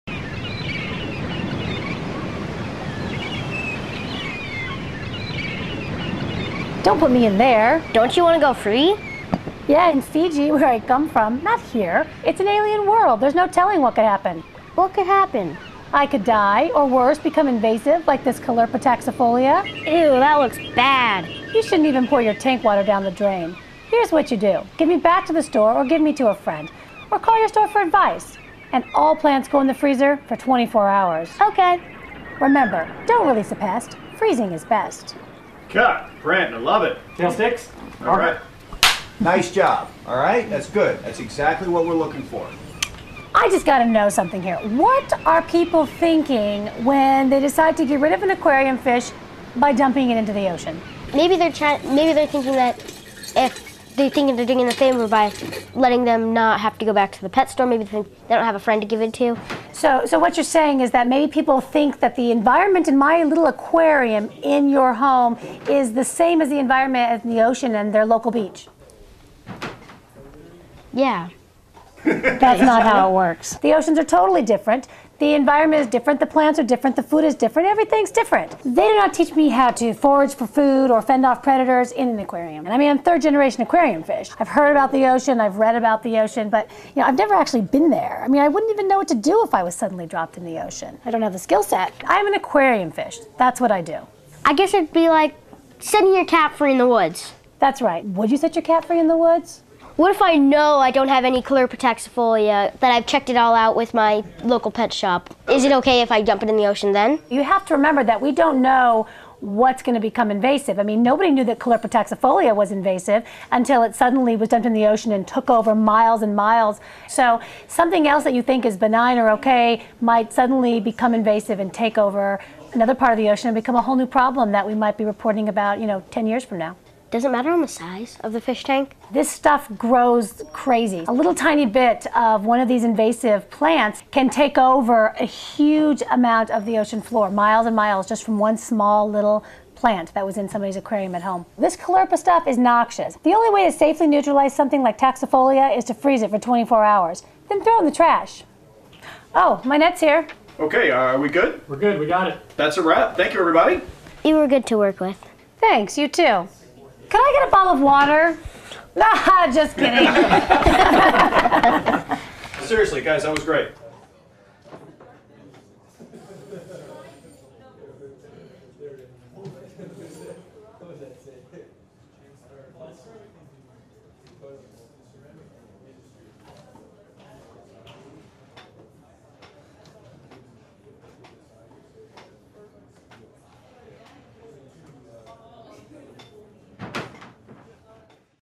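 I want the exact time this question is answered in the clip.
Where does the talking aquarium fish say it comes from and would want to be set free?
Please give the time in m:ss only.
0:10.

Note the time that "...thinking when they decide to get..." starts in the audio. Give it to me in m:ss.
0:45.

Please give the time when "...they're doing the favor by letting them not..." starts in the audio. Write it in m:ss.
0:54.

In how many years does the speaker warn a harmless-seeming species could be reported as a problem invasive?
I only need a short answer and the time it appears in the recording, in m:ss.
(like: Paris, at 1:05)
10, at 2:06.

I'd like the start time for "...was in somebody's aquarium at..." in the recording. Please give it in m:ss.
2:20.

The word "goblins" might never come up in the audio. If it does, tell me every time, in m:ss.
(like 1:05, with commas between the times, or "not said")
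not said.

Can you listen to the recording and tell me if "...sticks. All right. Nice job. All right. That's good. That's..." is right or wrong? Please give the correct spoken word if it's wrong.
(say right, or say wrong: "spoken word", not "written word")
right.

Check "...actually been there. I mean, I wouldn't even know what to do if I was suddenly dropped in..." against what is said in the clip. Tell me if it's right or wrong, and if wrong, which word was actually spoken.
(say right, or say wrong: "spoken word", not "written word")
right.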